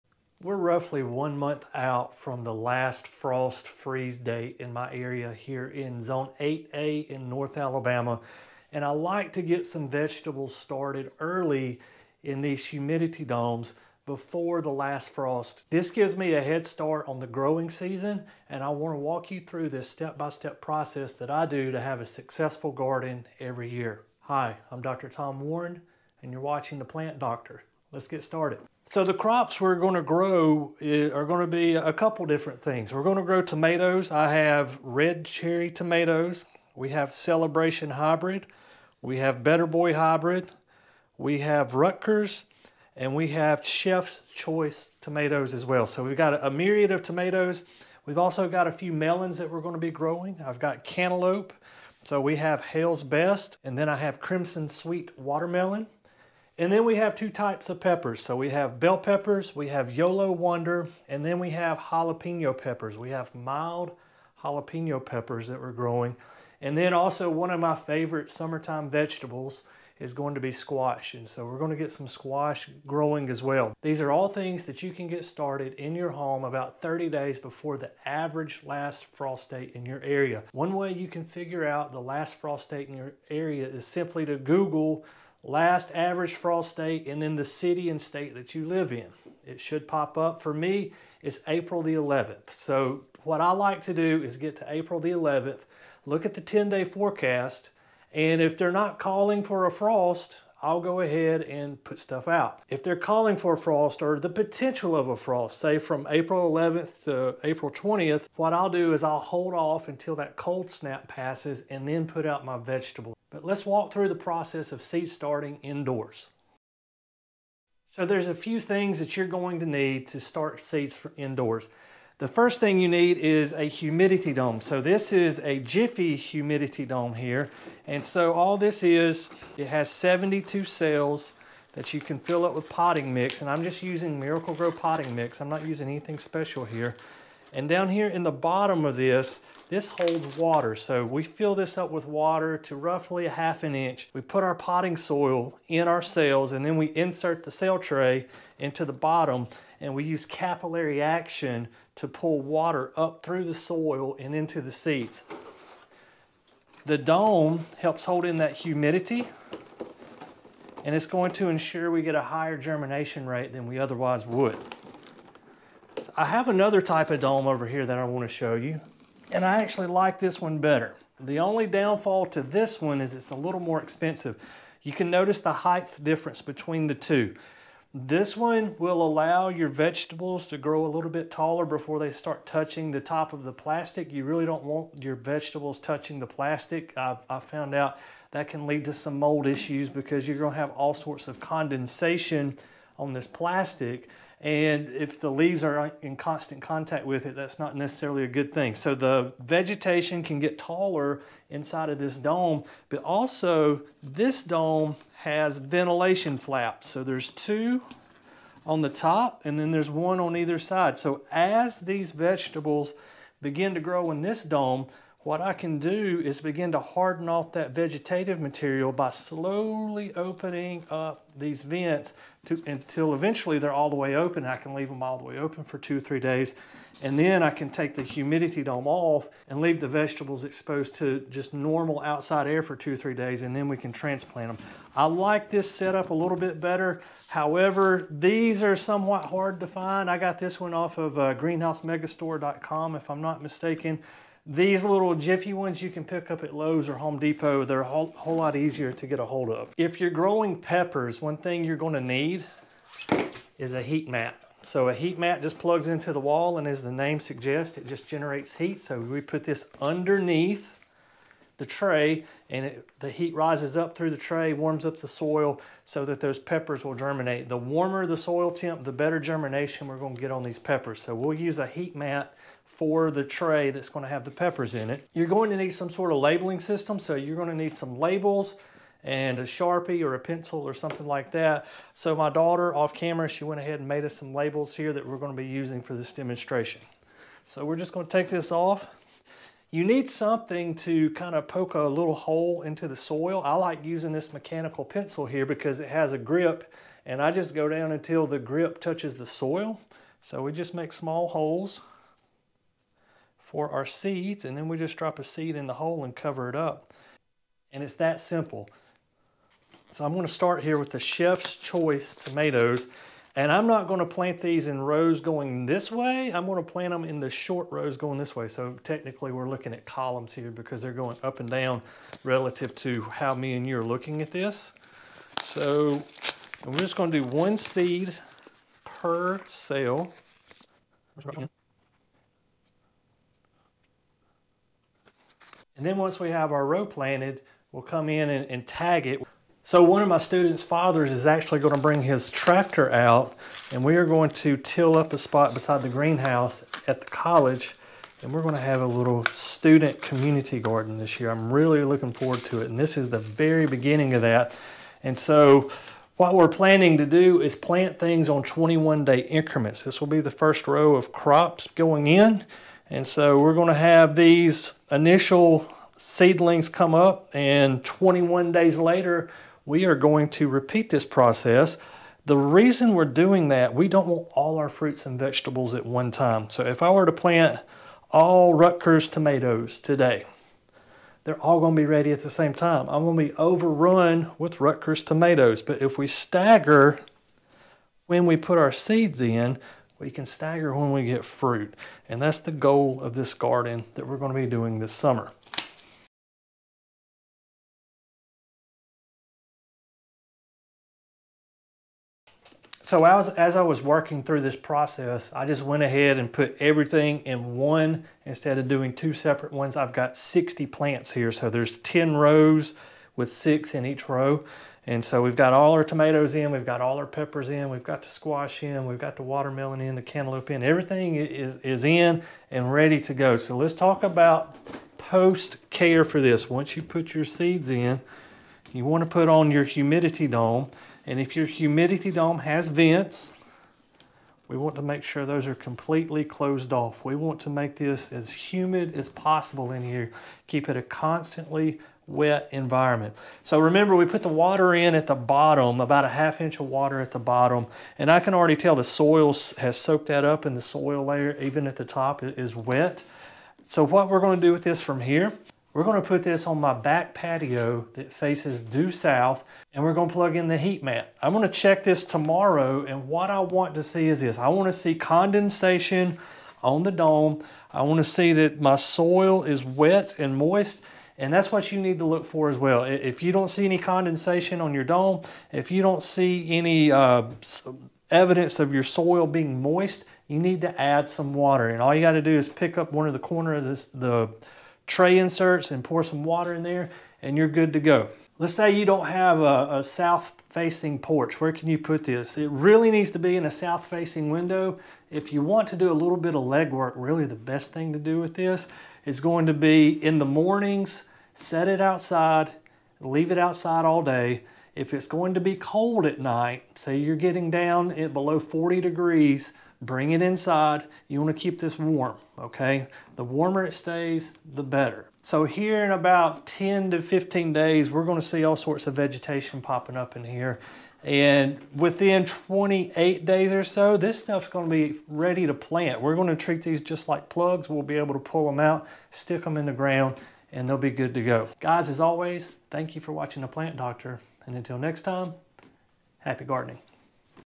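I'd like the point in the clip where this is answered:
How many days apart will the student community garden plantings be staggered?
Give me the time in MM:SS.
05:58.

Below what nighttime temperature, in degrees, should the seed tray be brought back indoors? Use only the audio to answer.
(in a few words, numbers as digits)
40.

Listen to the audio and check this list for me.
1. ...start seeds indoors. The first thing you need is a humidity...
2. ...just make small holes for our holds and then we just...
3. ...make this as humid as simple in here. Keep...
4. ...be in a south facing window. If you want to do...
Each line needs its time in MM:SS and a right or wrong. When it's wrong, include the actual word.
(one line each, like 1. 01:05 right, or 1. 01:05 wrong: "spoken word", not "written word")
1. 02:00 right
2. 05:00 wrong: "seeds", not "holds"
3. 07:17 wrong: "possible", not "simple"
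4. 08:13 right.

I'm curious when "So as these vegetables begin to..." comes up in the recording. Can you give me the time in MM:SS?
03:30.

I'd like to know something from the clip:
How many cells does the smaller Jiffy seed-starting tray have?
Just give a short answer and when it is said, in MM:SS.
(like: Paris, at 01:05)
72, at 02:09.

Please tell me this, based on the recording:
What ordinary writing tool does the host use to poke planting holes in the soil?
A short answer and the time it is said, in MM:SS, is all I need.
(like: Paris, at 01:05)
Mechanical pencil, at 04:54.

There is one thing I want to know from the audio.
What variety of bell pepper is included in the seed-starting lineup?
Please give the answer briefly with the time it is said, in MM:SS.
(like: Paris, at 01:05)
Yolo Wonder, at 00:59.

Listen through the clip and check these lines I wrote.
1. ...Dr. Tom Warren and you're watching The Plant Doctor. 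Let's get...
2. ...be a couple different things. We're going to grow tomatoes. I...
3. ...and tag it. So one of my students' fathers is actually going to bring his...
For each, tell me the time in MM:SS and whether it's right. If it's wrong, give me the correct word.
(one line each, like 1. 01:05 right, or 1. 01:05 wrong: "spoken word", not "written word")
1. 00:24 right
2. 00:31 right
3. 05:38 right.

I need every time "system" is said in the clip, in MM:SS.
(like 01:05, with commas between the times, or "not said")
04:36.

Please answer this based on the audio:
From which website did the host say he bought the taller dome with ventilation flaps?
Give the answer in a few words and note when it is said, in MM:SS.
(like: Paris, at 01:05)
greenhousemegastore.com, at 04:01.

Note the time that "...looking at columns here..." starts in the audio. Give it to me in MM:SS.
05:19.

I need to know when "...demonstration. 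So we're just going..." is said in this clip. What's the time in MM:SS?
04:46.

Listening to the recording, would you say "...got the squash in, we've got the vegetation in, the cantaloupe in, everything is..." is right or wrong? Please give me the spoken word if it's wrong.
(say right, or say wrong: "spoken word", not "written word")
wrong: "watermelon", not "vegetation".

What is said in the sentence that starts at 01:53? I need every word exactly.
But let's walk through the process of seed starting indoors.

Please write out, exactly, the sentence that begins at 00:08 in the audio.
And I like to get some vegetables started early in these humidity domes before the last frost.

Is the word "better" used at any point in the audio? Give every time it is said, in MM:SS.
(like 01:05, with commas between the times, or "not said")
00:39, 02:50, 03:56, 04:28, 08:34.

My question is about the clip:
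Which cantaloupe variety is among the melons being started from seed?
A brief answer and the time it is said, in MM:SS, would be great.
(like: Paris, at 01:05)
Hale's Best, at 00:52.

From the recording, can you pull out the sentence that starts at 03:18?
So the vegetation can get taller inside of this dome, but also this dome has ventilation flaps.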